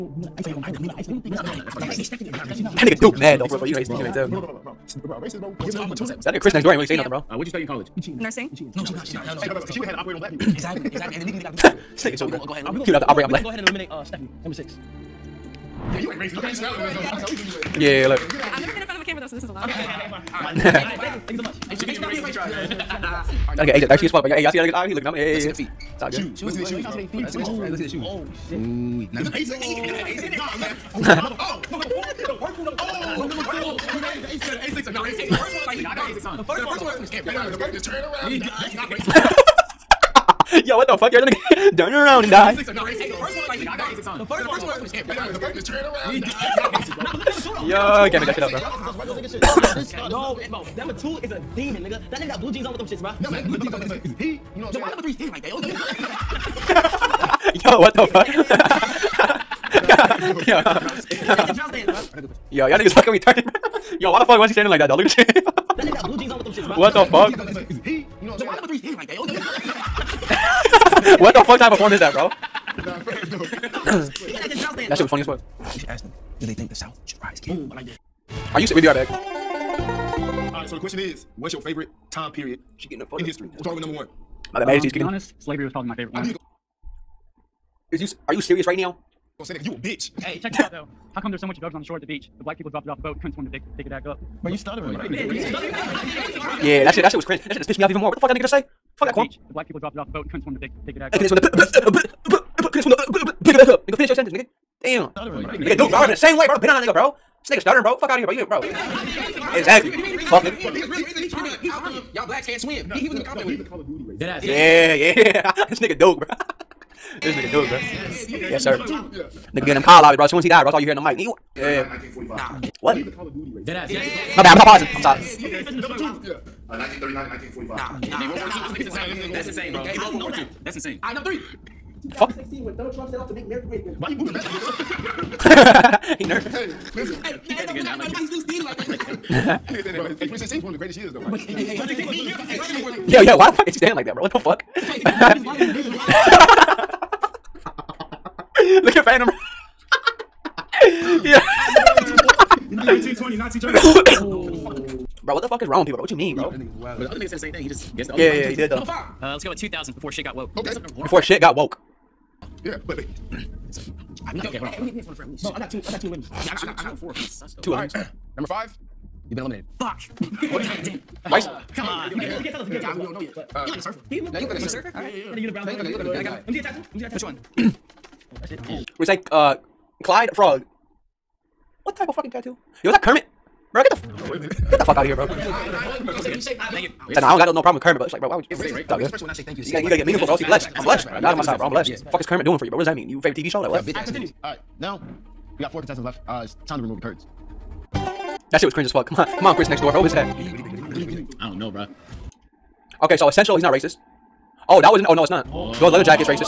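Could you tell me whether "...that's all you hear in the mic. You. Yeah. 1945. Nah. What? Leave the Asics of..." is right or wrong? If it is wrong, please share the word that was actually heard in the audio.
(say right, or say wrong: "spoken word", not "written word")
wrong: "Call", not "Asics".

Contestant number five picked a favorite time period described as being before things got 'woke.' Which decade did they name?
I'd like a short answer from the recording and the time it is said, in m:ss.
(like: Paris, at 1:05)
2000s, at 2:39.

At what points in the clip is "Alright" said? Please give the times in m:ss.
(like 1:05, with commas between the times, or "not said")
2:44.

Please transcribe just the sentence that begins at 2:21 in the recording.
Like, but, hey, hey, hey, 2016 was one of the greatest years.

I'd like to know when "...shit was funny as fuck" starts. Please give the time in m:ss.
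1:14.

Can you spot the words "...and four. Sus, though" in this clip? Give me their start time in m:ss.
2:46.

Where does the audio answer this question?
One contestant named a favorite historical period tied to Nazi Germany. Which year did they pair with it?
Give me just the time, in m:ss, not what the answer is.
2:32.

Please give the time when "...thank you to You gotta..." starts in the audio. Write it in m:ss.
3:09.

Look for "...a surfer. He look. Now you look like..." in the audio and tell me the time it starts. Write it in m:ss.
2:53.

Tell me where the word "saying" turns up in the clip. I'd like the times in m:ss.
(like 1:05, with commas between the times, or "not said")
0:06, 0:54.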